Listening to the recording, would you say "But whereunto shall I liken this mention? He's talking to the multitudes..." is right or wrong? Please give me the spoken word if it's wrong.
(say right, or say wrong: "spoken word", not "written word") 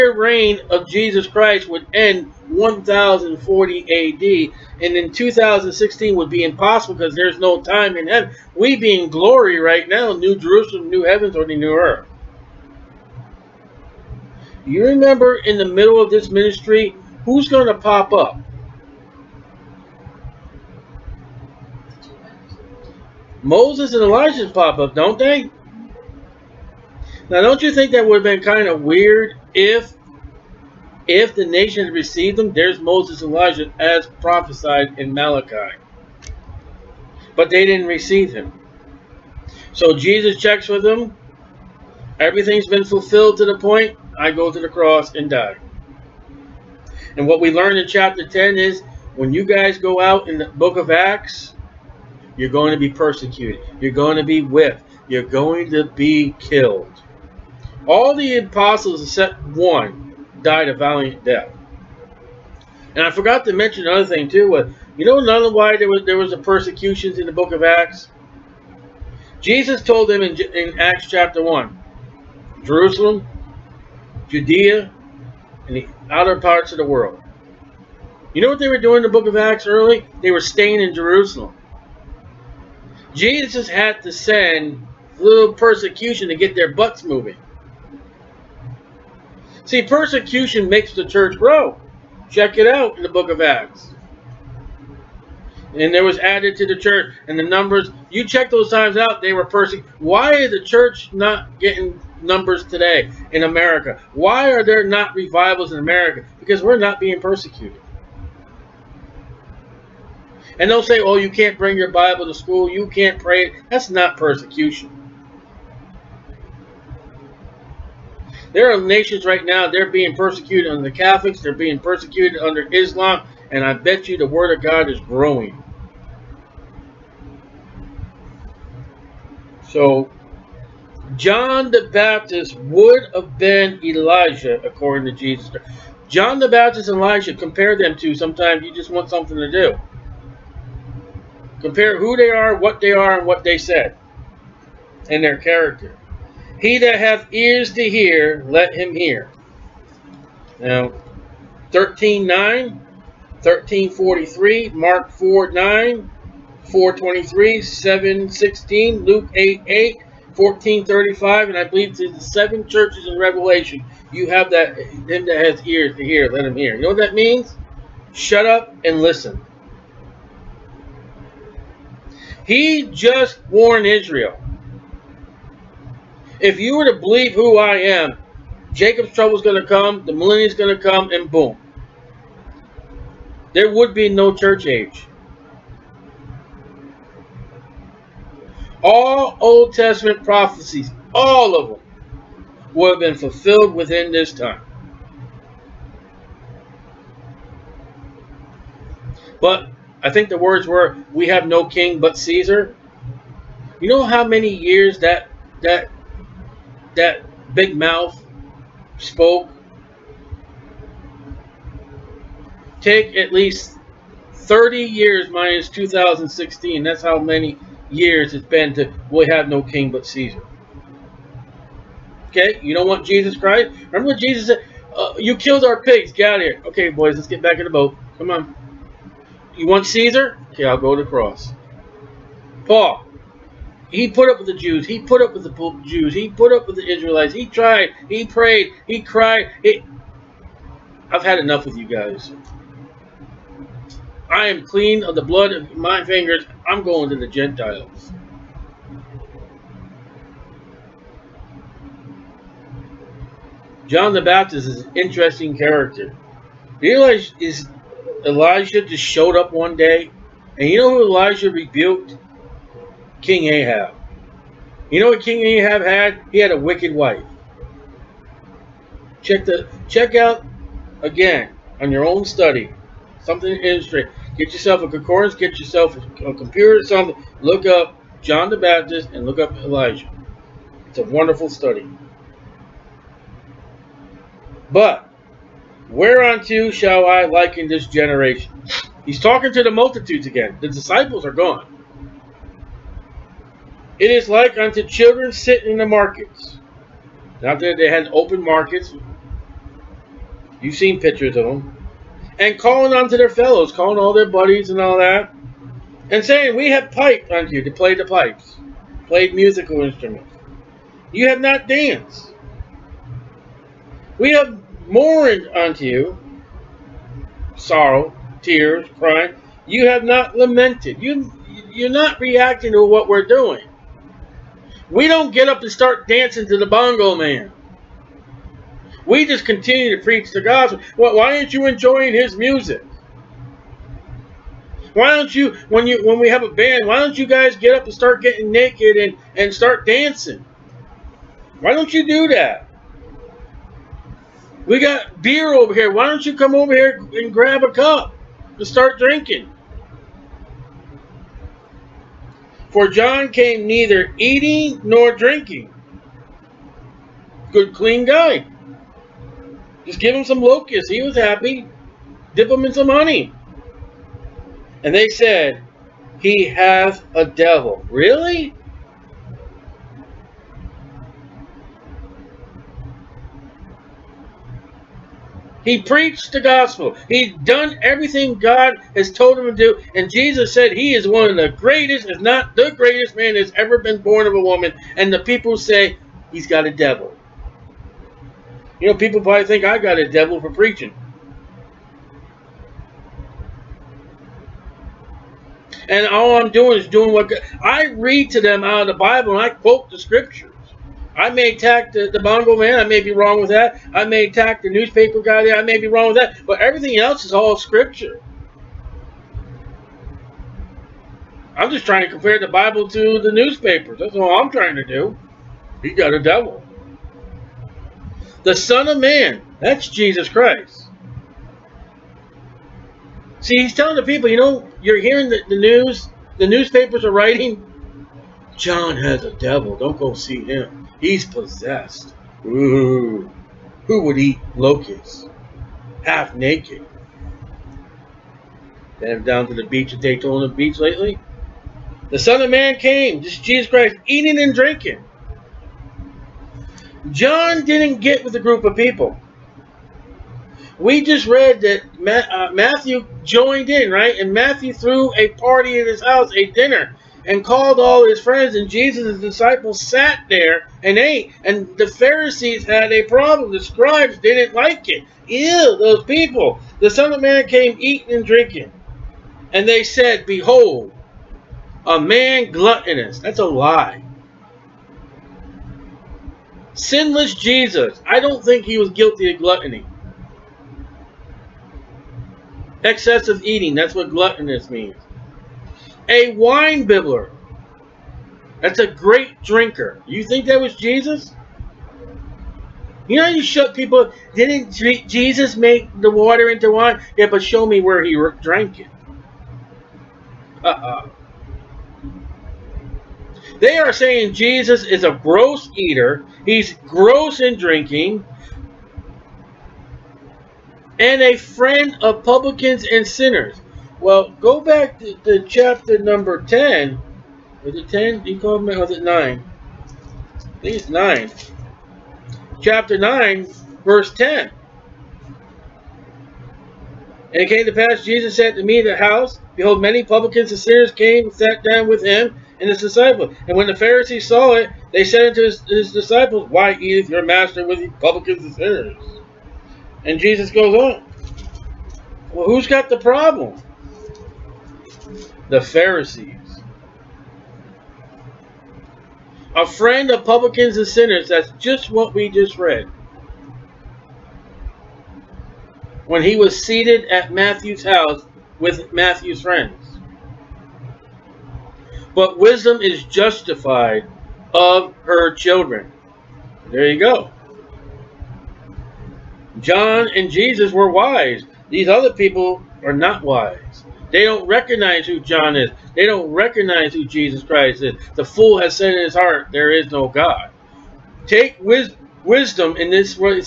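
wrong: "generation", not "mention".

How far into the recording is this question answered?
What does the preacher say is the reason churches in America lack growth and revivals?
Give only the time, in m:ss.
1:46.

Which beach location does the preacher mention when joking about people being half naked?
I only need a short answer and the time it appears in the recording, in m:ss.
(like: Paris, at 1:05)
Daytona Beach, at 7:20.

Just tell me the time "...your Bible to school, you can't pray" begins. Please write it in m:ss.
1:51.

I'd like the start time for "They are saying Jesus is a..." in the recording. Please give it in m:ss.
8:23.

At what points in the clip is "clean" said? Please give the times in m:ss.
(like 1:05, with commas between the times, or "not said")
4:04, 5:57.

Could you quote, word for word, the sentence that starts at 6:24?
And the people say he's got a devil.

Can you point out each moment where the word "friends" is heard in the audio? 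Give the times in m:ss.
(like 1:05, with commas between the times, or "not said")
7:38, 8:31, 9:09, 9:19.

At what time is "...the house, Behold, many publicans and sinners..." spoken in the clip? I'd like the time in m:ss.
8:48.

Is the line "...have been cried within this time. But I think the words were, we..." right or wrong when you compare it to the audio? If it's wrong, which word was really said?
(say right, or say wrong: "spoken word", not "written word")
wrong: "fulfilled", not "cried".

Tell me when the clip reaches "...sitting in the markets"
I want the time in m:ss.
4:55.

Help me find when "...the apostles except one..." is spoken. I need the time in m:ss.
0:58.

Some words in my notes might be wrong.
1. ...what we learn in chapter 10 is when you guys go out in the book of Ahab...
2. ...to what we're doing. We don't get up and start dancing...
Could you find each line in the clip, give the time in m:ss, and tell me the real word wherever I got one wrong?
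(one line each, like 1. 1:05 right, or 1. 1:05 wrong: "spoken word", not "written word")
1. 0:47 wrong: "Acts", not "Ahab"
2. 5:22 right.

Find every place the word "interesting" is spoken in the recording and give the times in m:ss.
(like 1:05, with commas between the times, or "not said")
4:14, 4:33.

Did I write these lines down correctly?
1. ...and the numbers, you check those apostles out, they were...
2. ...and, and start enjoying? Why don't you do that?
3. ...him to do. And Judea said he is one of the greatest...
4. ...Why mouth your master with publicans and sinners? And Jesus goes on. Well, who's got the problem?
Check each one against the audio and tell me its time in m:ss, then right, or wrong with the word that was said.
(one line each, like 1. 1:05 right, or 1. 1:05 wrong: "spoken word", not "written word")
1. 1:37 wrong: "times", not "apostles"
2. 5:38 wrong: "dancing", not "enjoying"
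3. 6:19 wrong: "Jesus", not "Judea"
4. 8:56 wrong: "eateth", not "mouth".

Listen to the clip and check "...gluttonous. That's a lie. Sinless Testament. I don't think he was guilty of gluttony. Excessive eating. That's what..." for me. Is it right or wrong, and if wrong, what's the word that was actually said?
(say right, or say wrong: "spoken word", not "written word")
wrong: "Jesus", not "Testament".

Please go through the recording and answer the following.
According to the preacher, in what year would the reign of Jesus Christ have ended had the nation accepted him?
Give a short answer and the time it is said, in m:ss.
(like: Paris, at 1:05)
1040 AD, at 0:02.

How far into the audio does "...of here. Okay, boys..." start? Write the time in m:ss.
3:46.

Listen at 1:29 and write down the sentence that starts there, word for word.
See, persecution makes the church grow.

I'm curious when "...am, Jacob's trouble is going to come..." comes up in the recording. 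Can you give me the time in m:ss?
2:57.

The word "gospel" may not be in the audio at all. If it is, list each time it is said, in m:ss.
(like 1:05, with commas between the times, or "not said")
5:30, 6:16.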